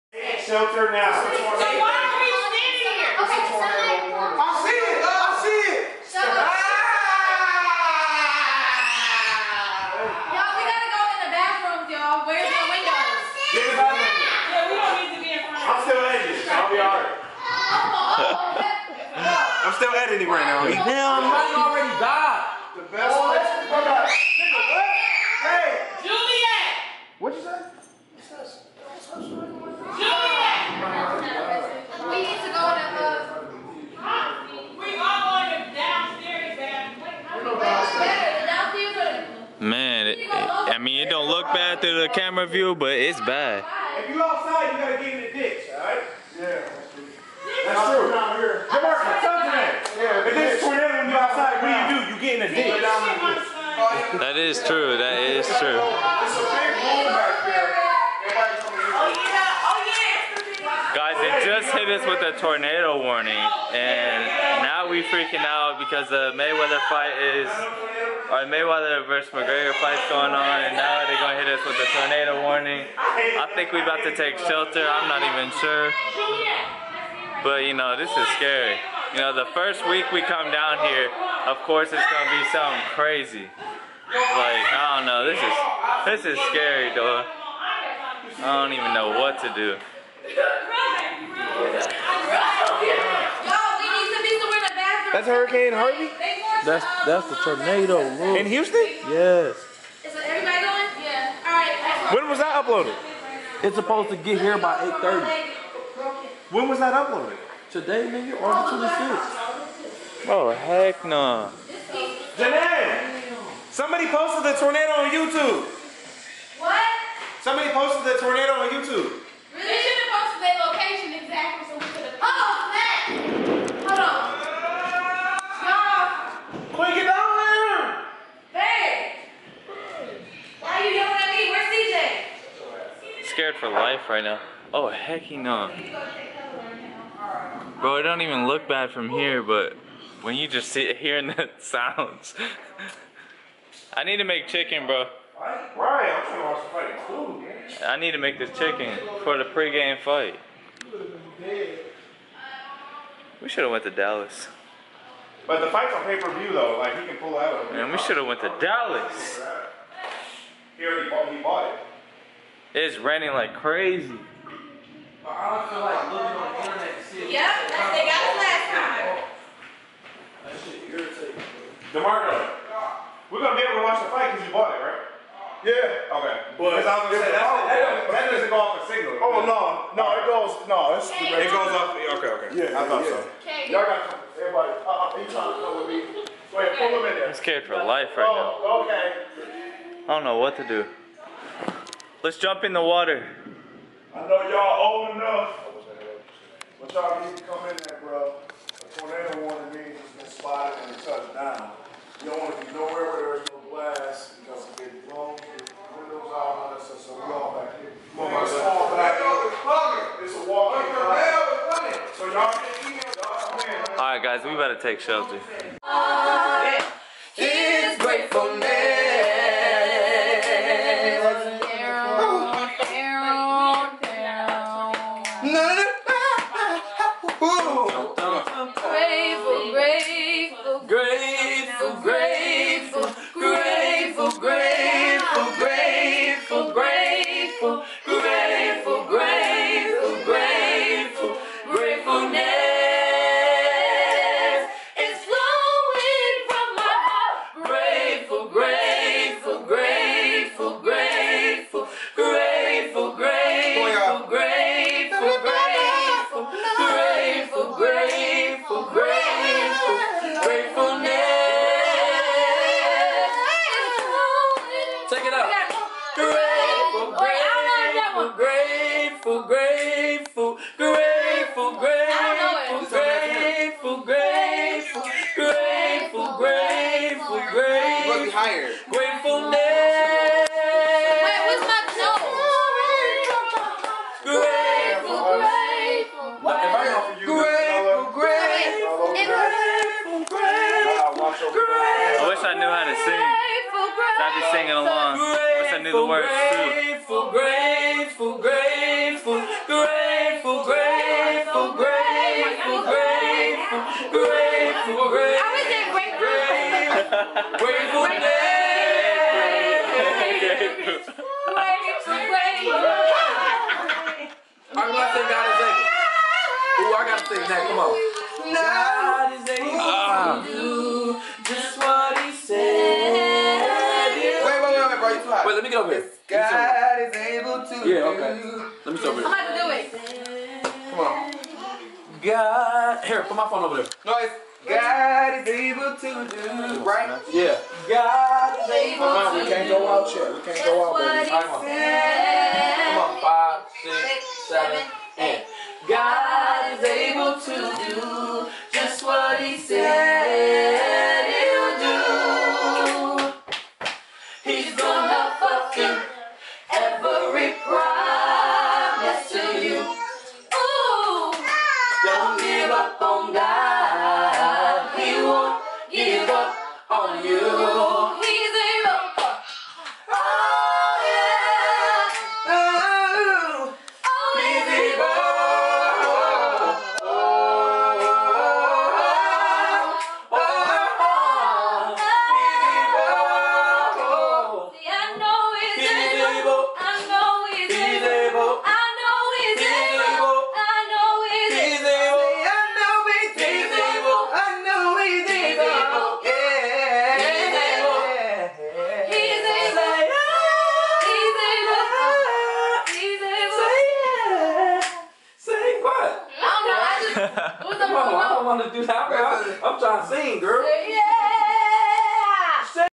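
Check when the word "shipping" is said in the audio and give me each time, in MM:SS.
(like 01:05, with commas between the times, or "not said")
not said.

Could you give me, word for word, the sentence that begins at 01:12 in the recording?
I think we're about to take shelter.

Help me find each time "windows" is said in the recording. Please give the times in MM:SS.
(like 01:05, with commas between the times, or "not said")
00:12, 03:25.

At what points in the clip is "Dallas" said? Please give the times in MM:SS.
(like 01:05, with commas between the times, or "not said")
02:33, 02:38.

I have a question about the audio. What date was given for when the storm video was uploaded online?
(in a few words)
the 26th.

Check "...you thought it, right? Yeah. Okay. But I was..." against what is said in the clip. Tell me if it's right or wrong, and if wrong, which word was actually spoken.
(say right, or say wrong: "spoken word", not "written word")
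wrong: "bought", not "thought".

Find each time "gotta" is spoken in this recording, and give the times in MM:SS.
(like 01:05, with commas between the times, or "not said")
00:10, 00:44, 05:17.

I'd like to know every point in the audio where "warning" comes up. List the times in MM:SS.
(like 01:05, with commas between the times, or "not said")
01:03, 01:12, 03:19.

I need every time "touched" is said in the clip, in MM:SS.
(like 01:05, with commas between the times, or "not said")
03:21.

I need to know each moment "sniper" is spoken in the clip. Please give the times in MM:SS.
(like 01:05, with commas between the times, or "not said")
not said.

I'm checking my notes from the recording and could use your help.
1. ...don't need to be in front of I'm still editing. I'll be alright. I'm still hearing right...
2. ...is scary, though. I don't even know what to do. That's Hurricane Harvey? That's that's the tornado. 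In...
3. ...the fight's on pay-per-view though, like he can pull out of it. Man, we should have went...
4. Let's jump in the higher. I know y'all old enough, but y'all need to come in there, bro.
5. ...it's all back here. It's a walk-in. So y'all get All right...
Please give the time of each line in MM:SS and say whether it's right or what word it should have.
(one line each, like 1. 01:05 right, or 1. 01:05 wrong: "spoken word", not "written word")
1. 00:14 wrong: "editing", not "hearing"
2. 01:26 right
3. 02:35 right
4. 03:12 wrong: "water", not "higher"
5. 03:28 right.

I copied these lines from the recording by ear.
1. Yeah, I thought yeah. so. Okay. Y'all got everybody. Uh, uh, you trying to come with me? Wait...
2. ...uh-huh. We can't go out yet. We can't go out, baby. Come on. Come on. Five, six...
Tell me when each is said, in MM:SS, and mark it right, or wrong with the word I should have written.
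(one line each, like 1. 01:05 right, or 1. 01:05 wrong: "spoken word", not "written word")
1. 03:02 right
2. 05:39 right.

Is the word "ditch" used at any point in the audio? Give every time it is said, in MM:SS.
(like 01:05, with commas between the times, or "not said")
00:45, 00:52.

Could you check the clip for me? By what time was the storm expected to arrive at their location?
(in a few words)
8:30.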